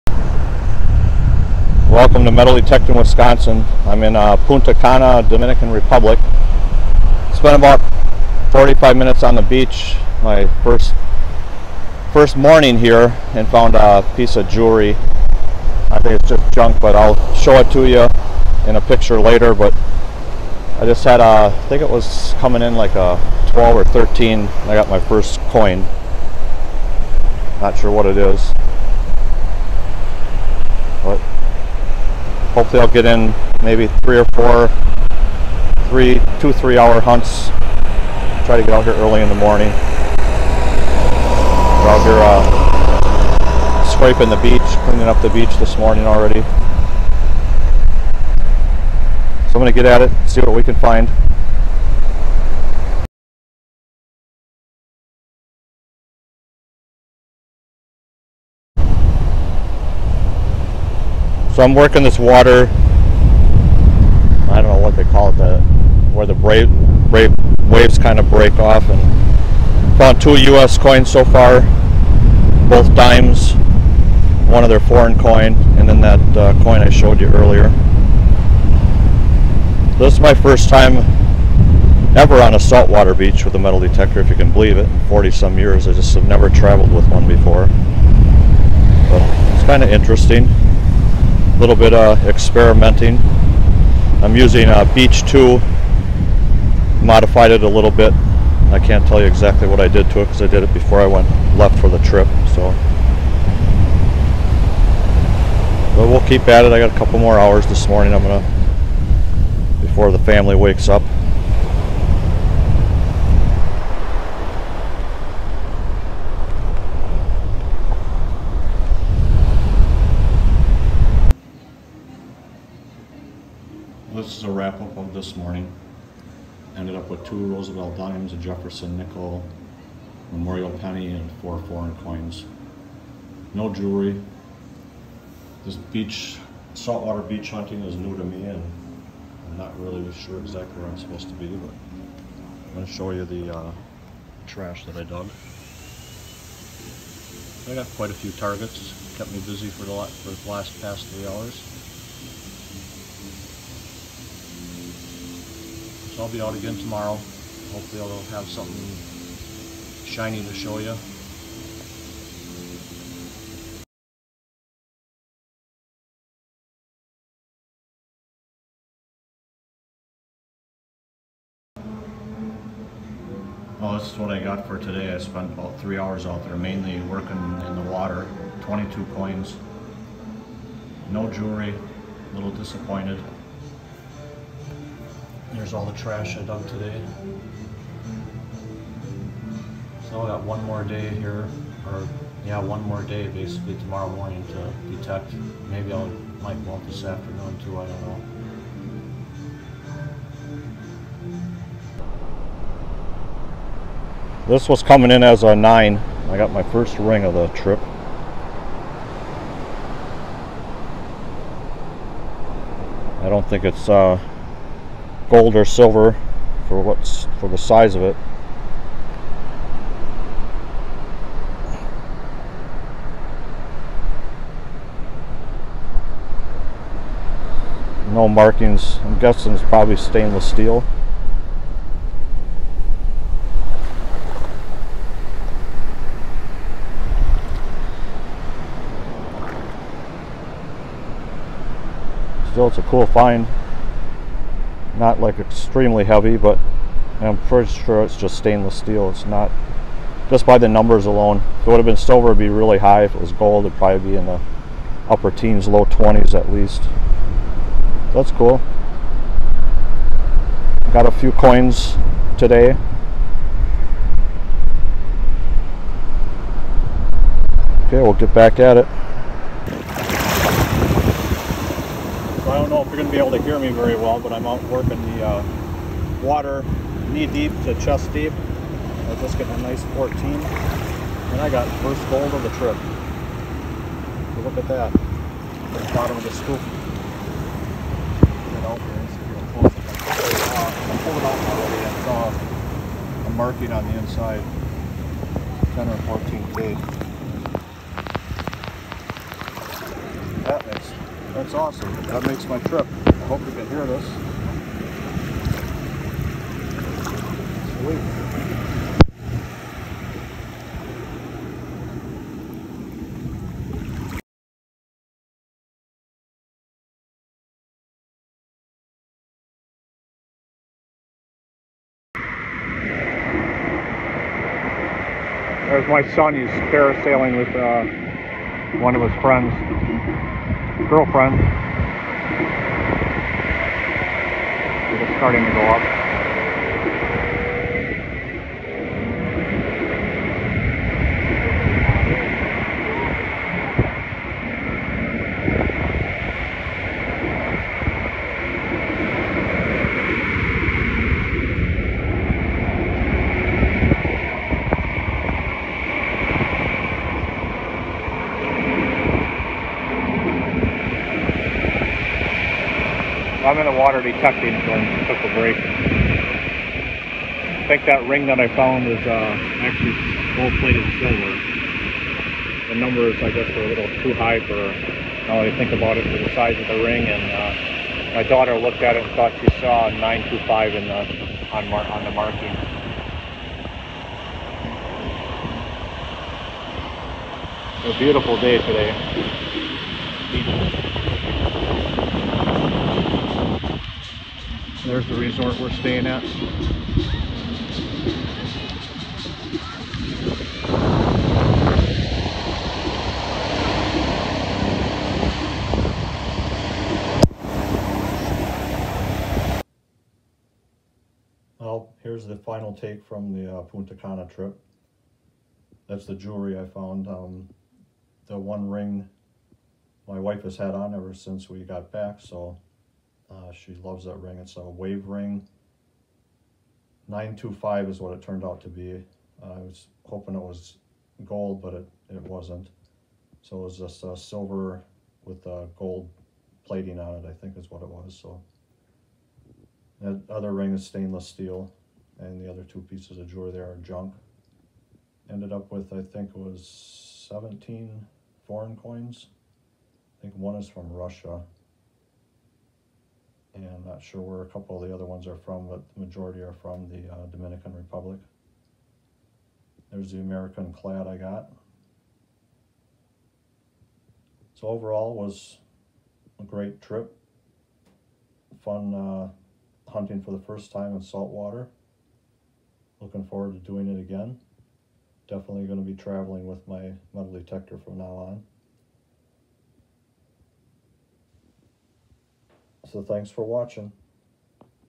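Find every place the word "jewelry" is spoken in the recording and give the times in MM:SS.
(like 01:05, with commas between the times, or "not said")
00:14, 02:13, 03:01, 06:56, 07:23.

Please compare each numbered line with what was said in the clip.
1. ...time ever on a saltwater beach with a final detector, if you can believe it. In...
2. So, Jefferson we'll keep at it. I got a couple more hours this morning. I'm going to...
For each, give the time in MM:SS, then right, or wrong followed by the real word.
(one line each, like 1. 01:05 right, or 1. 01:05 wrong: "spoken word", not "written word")
1. 01:20 wrong: "metal", not "final"
2. 01:42 wrong: "But", not "Jefferson".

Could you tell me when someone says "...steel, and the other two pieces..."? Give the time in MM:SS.
07:21.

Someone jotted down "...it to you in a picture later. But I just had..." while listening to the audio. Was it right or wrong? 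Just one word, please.
right.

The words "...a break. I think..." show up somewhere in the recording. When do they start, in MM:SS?
06:05.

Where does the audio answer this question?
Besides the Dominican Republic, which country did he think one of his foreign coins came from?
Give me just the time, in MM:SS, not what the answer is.
07:30.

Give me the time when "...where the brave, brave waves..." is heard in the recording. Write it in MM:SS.
01:06.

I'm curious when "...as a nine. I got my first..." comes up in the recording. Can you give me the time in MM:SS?
03:25.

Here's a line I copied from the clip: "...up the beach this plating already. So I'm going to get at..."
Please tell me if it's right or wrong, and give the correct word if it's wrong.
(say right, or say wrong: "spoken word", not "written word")
wrong: "morning", not "plating".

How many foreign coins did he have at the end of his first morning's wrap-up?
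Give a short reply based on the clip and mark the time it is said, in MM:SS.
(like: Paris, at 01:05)
4, at 02:11.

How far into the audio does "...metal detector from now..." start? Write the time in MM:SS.
07:57.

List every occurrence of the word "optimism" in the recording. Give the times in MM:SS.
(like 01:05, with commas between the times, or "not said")
not said.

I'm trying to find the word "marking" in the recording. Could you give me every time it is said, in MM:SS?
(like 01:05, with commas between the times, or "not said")
03:48, 04:53, 06:22.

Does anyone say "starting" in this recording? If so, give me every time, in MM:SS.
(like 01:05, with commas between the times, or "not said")
05:35.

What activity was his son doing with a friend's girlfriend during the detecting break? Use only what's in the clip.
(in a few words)
Parasailing.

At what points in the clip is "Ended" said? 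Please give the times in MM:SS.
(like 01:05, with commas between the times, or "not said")
02:06, 07:25.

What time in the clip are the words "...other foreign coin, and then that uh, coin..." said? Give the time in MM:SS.
01:14.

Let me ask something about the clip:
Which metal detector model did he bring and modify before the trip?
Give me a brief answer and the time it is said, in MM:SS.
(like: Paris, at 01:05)
Beach 2, at 01:34.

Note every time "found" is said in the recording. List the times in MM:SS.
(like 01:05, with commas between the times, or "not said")
00:13, 01:09, 06:08, 06:56.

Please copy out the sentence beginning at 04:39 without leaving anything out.
I just getting a nice 14, and I got first gold of the trip.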